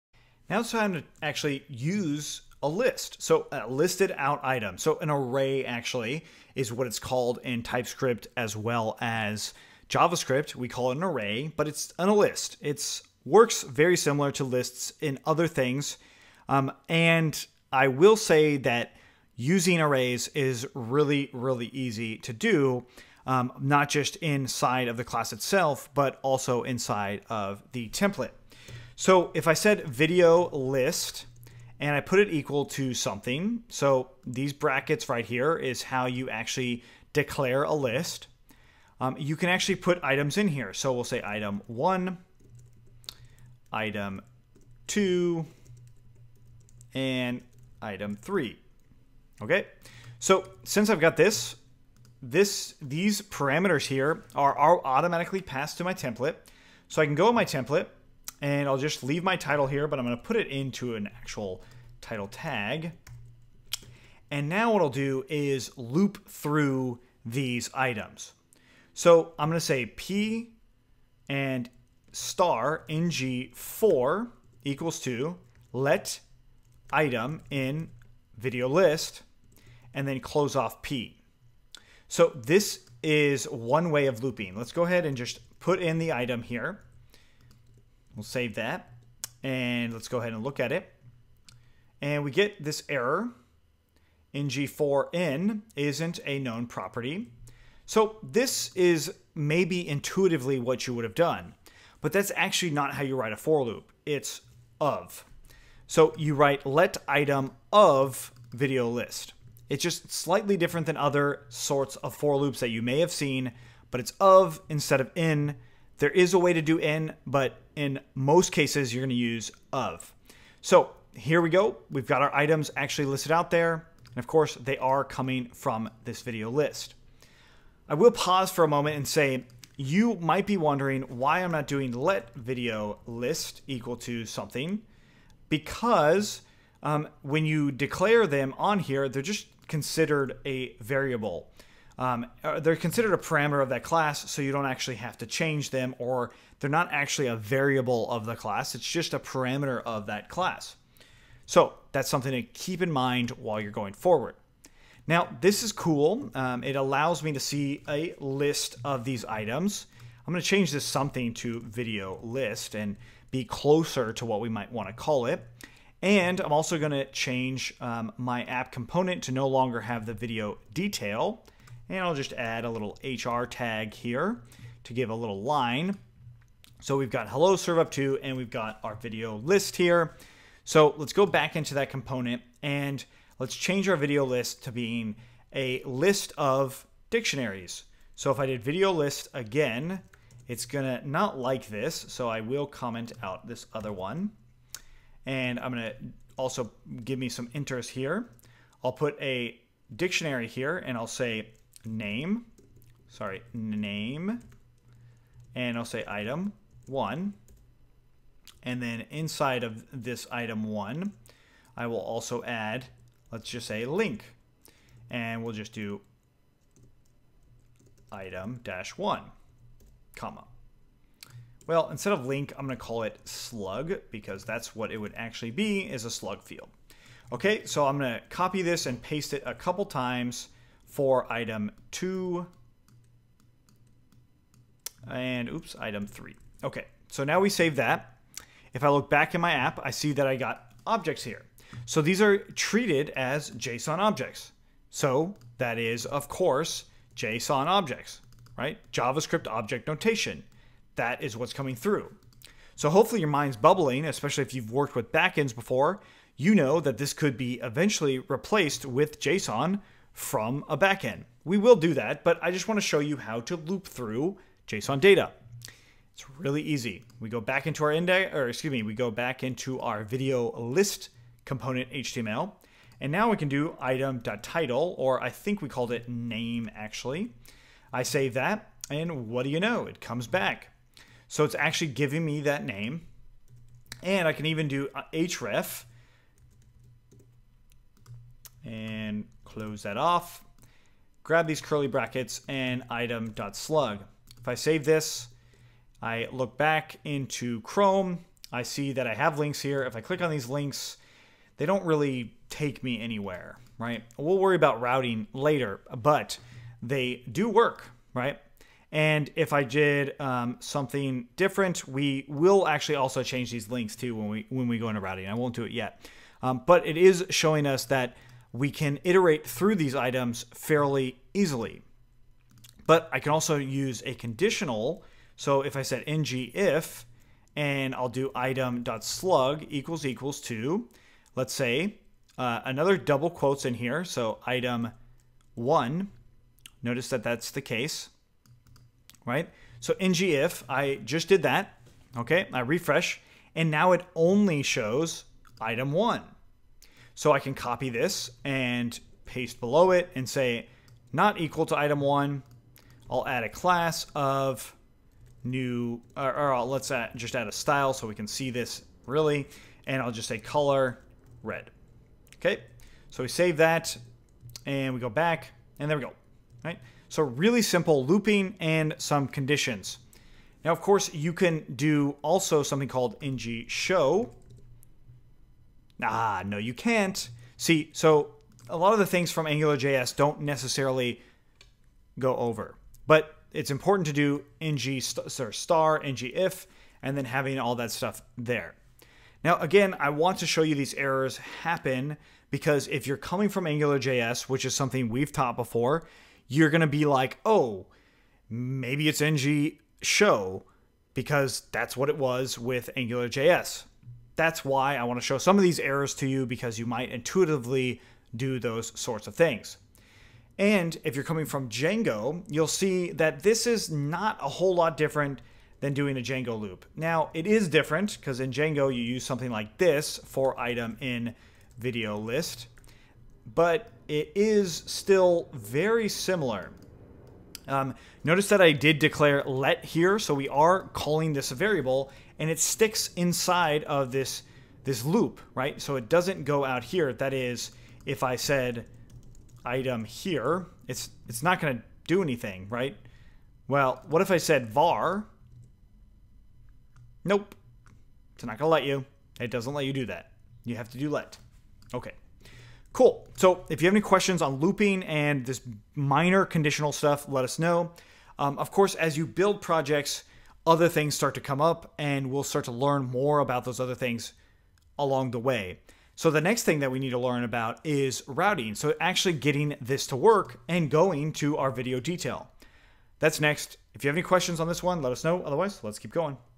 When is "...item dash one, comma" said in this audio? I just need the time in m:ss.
3:38.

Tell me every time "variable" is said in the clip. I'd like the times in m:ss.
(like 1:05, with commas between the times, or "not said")
2:20, 2:27, 7:11.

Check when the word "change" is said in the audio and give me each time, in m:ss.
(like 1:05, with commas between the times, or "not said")
2:25, 2:40, 2:47, 3:03, 5:13.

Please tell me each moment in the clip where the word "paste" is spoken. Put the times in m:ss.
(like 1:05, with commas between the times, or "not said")
3:49, 5:49.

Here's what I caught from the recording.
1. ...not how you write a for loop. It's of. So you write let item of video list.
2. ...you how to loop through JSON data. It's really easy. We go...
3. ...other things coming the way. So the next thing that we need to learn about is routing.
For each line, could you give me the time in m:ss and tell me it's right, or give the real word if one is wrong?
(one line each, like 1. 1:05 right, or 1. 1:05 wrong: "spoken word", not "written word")
1. 1:42 right
2. 4:22 right
3. 7:43 wrong: "along", not "coming".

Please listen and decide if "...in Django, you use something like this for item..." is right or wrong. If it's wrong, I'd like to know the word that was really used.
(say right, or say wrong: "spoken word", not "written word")
right.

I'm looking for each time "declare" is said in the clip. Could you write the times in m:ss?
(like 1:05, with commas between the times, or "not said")
0:37, 2:17, 7:08.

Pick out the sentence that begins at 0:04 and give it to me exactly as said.
So an array actually is what it's called in TypeScript as well as JavaScript.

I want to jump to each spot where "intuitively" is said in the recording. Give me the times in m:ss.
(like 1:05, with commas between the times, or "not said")
1:39, 6:47.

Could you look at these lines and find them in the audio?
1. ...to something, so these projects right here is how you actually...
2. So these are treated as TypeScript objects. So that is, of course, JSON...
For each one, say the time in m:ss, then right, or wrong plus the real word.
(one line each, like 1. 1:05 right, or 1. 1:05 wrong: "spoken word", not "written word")
1. 0:32 wrong: "brackets", not "projects"
2. 4:01 wrong: "JSON", not "TypeScript".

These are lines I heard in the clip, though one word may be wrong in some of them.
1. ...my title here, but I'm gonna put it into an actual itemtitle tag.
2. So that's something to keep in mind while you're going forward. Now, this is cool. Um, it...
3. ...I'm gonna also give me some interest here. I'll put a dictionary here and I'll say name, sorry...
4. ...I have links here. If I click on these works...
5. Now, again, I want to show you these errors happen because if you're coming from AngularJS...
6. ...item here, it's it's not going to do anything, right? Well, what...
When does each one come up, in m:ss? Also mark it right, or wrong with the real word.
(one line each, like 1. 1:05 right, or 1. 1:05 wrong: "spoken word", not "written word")
1. 0:59 wrong: "title", not "itemtitle"
2. 2:31 right
3. 3:15 right
4. 4:59 wrong: "links", not "works"
5. 6:29 right
6. 7:19 right.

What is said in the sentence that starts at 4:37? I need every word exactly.
I save that, and what do you know?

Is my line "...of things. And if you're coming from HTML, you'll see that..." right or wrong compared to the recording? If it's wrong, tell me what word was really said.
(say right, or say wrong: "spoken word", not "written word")
wrong: "Django", not "HTML".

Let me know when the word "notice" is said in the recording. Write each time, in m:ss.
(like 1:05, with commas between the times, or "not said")
5:36, 7:08.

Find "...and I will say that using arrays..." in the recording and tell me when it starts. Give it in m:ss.
0:16.